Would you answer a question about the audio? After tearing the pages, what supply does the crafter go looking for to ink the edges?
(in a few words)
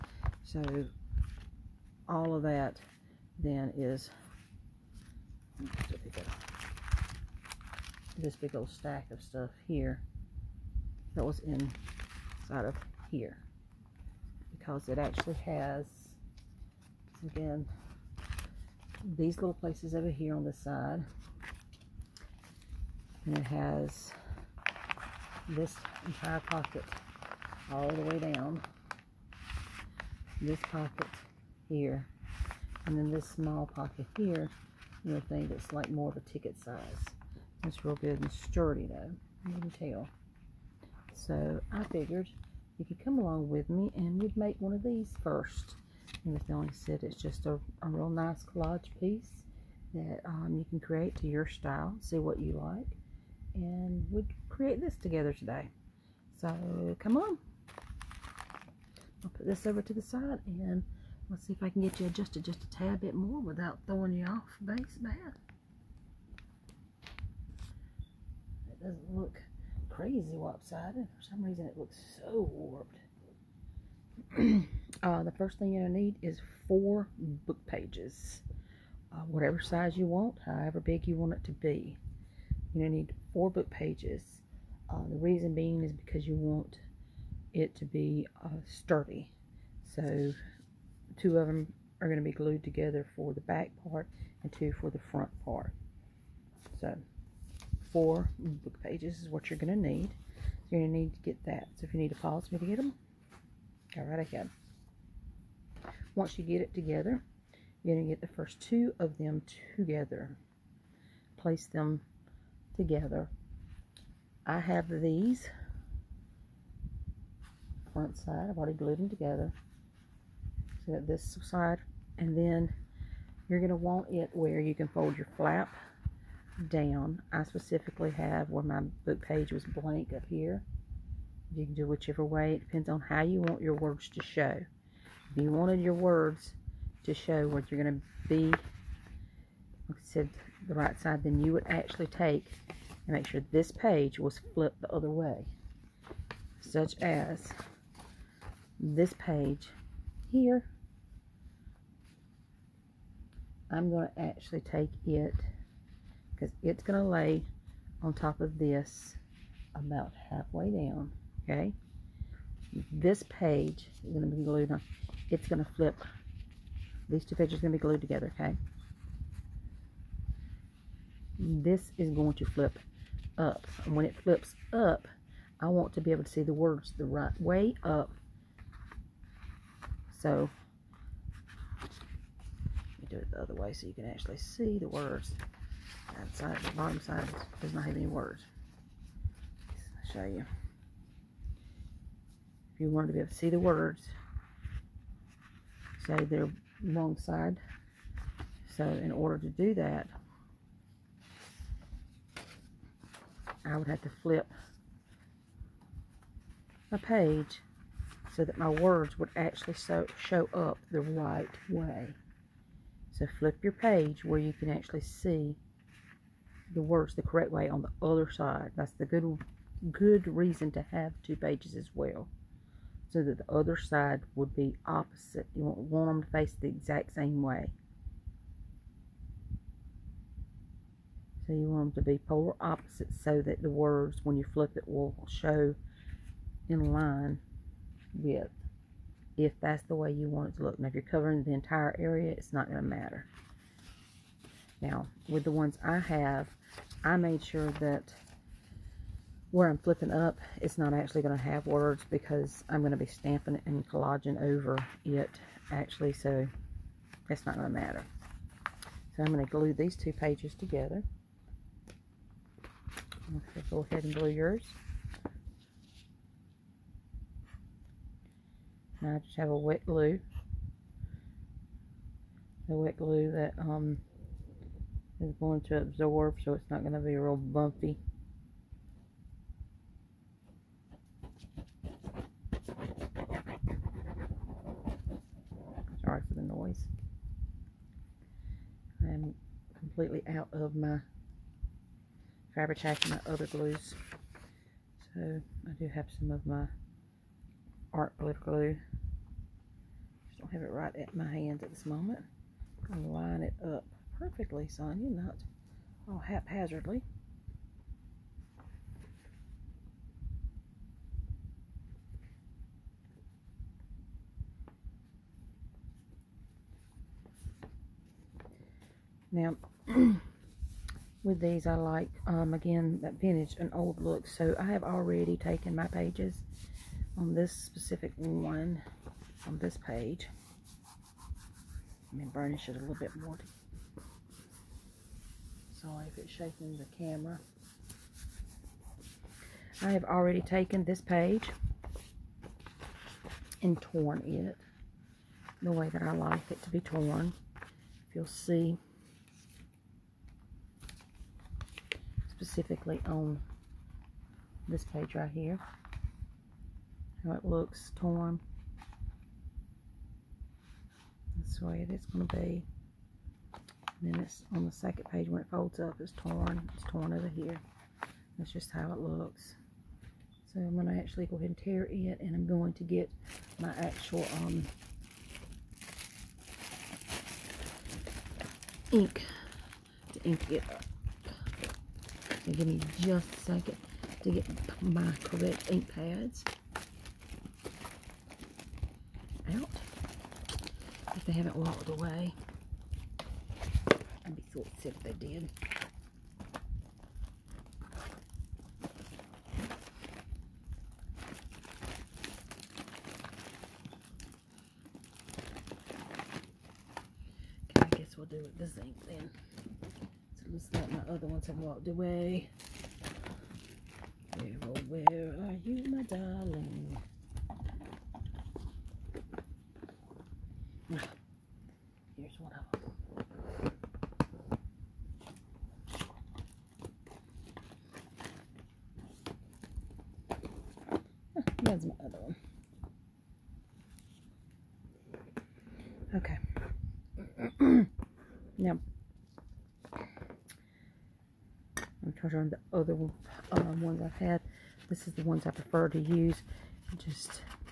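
ink pads.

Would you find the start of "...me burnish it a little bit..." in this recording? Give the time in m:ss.
5:32.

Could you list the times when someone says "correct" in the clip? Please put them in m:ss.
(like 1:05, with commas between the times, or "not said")
3:37, 6:25.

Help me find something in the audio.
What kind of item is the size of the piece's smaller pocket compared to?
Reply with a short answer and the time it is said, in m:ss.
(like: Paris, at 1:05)
a ticket, at 0:36.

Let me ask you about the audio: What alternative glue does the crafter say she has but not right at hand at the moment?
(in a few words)
art glitter glue.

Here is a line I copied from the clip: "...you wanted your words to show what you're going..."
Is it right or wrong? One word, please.
right.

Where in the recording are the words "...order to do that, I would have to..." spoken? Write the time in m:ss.
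3:19.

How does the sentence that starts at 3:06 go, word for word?
That side, the bottom side does not have any words.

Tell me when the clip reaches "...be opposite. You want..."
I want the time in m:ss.
3:44.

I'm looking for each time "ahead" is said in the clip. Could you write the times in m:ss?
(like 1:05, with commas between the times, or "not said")
1:44, 4:23, 6:11.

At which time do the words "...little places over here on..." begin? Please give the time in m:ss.
0:19.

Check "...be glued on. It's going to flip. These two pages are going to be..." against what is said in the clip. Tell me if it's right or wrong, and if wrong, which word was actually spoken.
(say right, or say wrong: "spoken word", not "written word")
right.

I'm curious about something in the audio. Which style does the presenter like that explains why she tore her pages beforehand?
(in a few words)
vintage and old.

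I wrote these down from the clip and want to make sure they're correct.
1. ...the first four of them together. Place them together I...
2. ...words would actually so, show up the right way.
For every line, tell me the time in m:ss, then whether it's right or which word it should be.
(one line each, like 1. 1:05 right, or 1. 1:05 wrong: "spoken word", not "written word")
1. 1:48 wrong: "two", not "four"
2. 3:28 right.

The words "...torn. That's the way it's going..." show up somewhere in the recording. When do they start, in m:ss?
5:57.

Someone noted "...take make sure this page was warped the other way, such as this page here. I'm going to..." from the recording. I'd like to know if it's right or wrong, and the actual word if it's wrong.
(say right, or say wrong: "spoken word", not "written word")
wrong: "flipped", not "warped".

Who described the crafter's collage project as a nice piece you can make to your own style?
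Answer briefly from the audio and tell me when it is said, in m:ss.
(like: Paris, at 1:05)
Melanie, at 0:46.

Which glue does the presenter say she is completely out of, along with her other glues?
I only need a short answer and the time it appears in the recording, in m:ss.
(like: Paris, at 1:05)
fabric tack, at 4:52.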